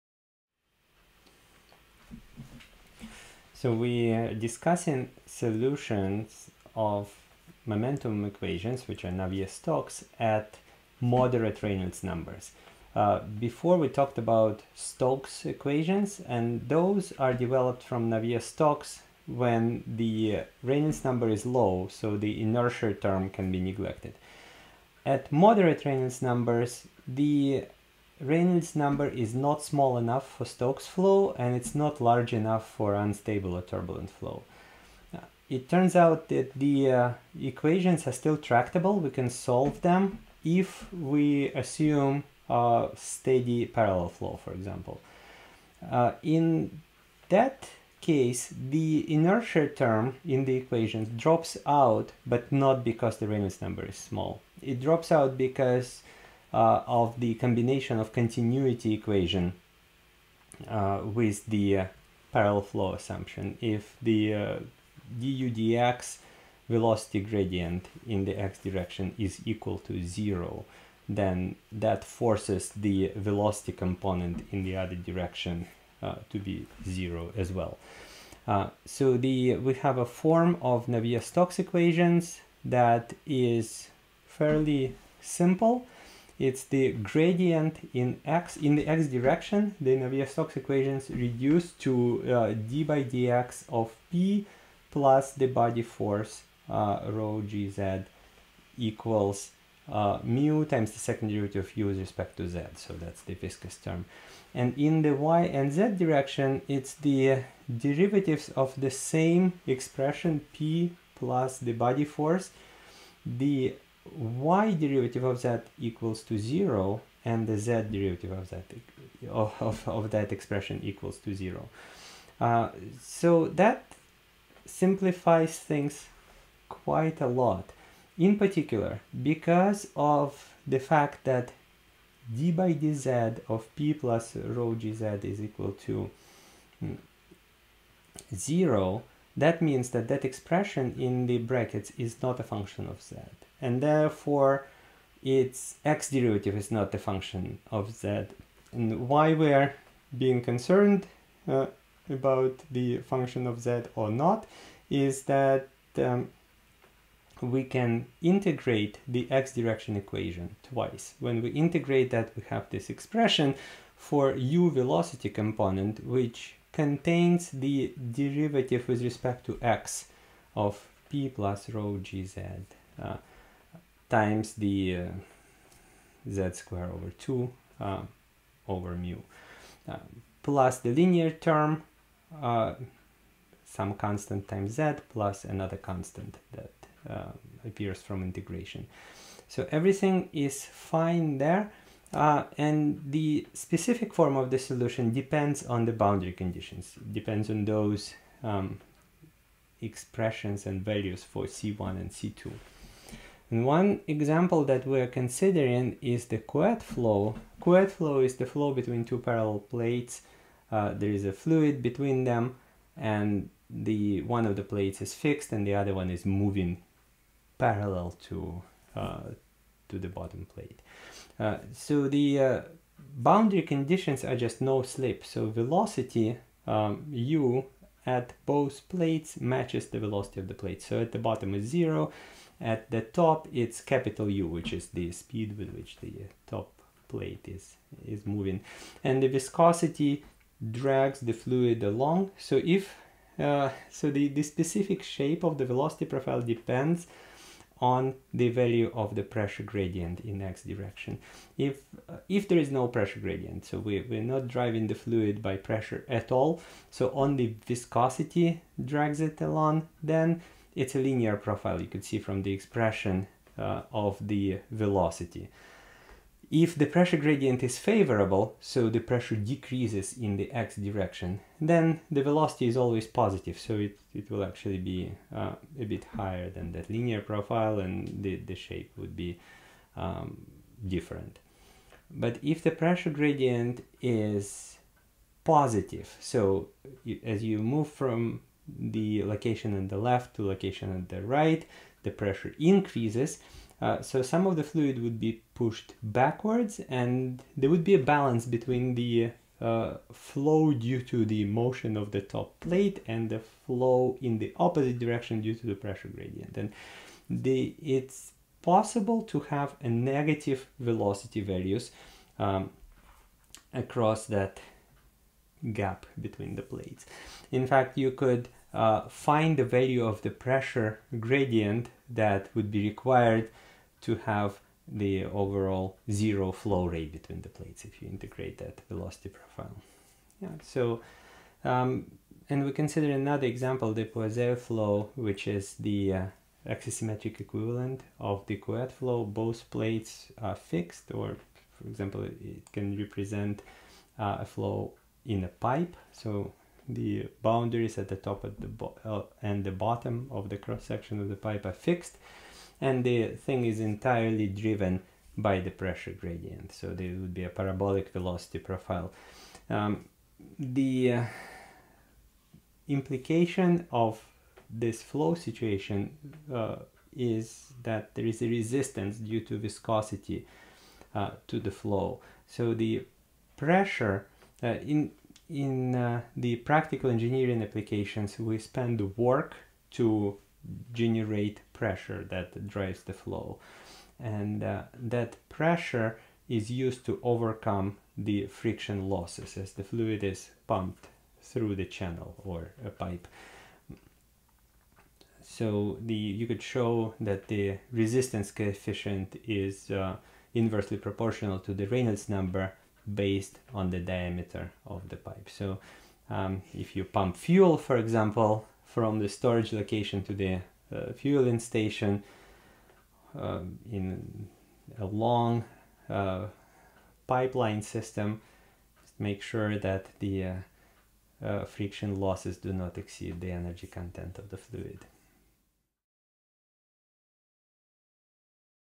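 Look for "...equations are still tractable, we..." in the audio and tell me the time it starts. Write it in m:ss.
0:37.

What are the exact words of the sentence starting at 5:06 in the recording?
And the, it's possible to have a negative velocity values um, across that gap between the plates.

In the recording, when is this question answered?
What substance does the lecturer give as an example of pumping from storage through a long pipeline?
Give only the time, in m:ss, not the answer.
6:47.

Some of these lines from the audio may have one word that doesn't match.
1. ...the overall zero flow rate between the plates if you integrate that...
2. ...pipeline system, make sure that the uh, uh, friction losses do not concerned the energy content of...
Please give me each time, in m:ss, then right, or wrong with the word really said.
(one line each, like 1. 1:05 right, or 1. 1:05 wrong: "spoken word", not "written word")
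1. 5:24 right
2. 6:57 wrong: "exceed", not "concerned".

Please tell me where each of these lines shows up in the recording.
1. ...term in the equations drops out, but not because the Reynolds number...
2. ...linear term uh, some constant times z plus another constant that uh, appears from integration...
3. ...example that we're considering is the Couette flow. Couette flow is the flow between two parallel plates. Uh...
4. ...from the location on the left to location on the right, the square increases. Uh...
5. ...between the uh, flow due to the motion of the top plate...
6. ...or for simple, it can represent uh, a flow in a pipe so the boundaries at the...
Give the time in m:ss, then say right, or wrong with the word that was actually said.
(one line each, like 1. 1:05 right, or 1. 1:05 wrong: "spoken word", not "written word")
1. 0:49 right
2. 3:00 right
3. 3:24 right
4. 4:47 wrong: "pressure", not "square"
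5. 4:58 right
6. 5:41 wrong: "example", not "simple".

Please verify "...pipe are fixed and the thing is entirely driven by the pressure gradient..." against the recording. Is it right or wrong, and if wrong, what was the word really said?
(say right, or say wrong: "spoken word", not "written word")
right.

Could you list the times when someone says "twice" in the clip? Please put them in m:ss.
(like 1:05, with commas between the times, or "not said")
2:40.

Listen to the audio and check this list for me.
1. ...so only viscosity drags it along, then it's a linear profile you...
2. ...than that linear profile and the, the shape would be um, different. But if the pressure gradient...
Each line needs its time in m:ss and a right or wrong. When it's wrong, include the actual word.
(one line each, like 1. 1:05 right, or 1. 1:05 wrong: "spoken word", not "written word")
1. 4:16 right
2. 4:36 right.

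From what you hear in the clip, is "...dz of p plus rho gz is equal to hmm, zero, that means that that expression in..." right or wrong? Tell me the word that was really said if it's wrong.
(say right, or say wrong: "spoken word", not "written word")
right.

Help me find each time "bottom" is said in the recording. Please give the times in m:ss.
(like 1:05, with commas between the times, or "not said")
3:40, 3:51, 5:49.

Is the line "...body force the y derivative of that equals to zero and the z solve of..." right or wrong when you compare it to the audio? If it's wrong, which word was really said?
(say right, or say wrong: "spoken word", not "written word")
wrong: "derivative", not "solve".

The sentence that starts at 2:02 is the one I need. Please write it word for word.
Uh, so that simplifies things quite a lot.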